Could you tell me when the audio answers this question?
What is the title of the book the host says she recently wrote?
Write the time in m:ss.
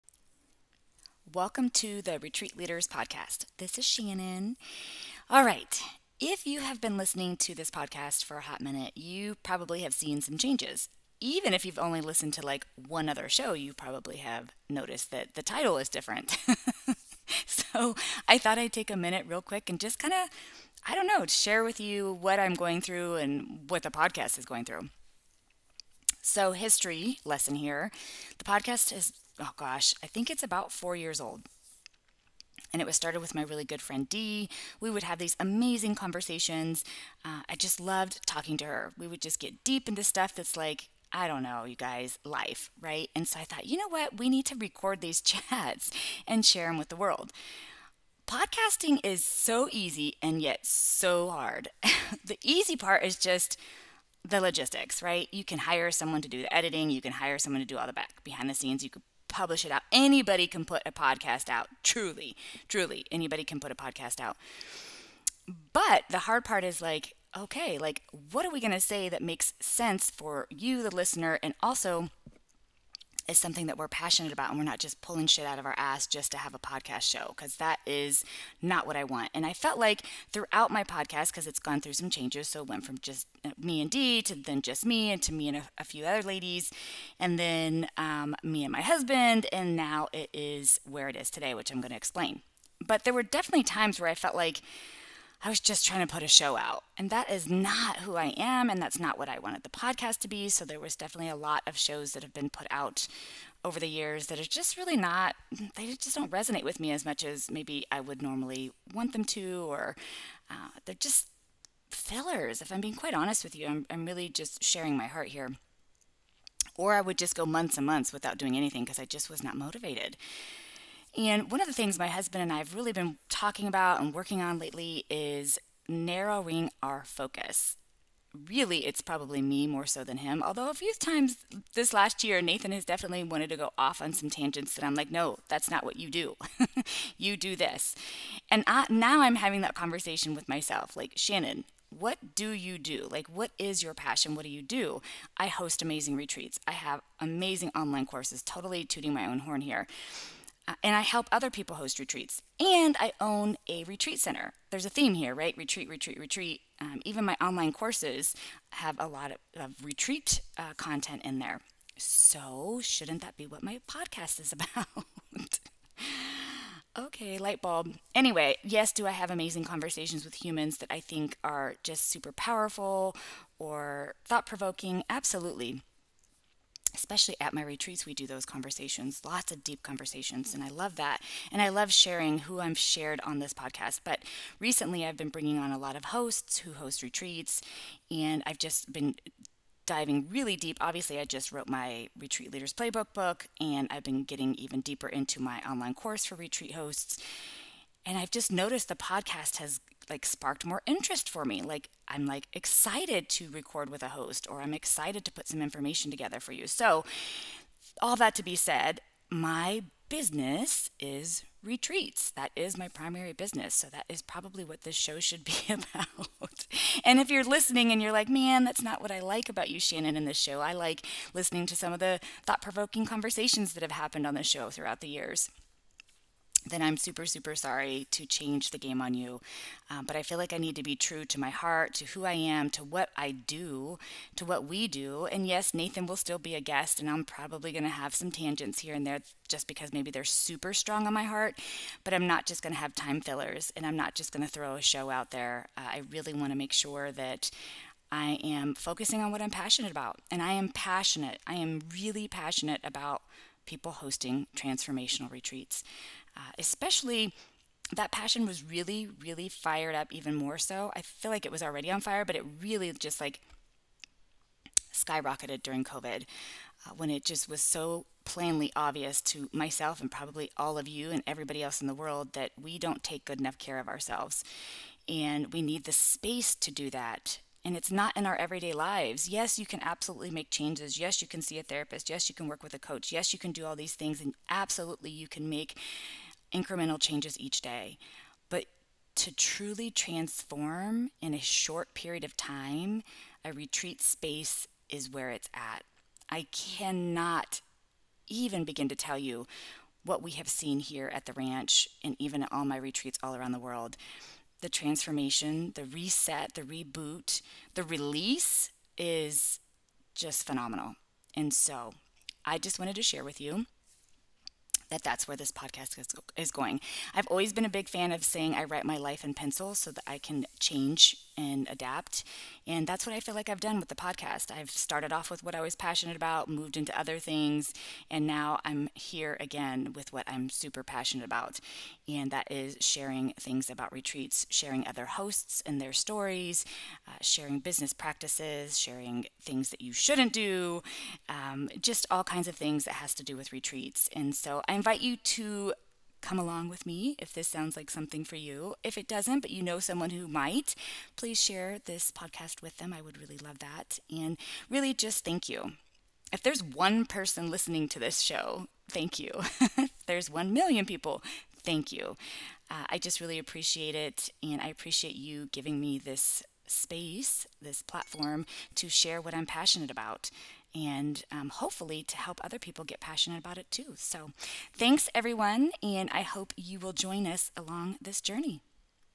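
3:12.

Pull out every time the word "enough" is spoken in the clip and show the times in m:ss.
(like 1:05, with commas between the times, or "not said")
4:33.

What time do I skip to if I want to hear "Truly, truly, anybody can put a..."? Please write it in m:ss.
1:01.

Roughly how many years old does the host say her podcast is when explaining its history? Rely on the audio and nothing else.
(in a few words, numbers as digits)
4.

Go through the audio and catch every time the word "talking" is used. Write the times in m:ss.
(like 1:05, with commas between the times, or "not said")
0:38, 2:03.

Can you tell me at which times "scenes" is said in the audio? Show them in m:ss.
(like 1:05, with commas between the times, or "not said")
0:58.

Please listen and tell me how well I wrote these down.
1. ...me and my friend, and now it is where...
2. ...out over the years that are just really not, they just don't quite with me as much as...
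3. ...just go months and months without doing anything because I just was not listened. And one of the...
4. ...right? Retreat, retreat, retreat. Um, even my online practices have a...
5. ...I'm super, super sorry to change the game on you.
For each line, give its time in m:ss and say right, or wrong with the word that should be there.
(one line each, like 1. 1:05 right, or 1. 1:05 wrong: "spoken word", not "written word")
1. 1:28 wrong: "husband", not "friend"
2. 1:42 wrong: "resonate", not "quite"
3. 1:57 wrong: "motivated", not "listened"
4. 2:35 wrong: "courses", not "practices"
5. 3:46 right.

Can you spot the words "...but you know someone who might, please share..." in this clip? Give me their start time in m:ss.
5:49.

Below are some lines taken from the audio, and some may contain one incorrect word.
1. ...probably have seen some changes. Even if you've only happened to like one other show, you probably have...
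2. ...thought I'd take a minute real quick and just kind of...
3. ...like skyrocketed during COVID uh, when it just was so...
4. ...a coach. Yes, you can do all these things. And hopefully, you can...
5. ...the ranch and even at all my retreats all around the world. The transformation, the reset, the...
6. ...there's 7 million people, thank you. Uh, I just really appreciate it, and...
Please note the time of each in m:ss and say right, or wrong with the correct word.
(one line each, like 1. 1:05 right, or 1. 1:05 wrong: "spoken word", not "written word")
1. 0:09 wrong: "listened", not "happened"
2. 0:18 right
3. 4:23 right
4. 4:42 wrong: "absolutely", not "hopefully"
5. 5:01 right
6. 6:00 wrong: "1", not "7".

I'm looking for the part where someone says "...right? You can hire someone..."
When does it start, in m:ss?
0:55.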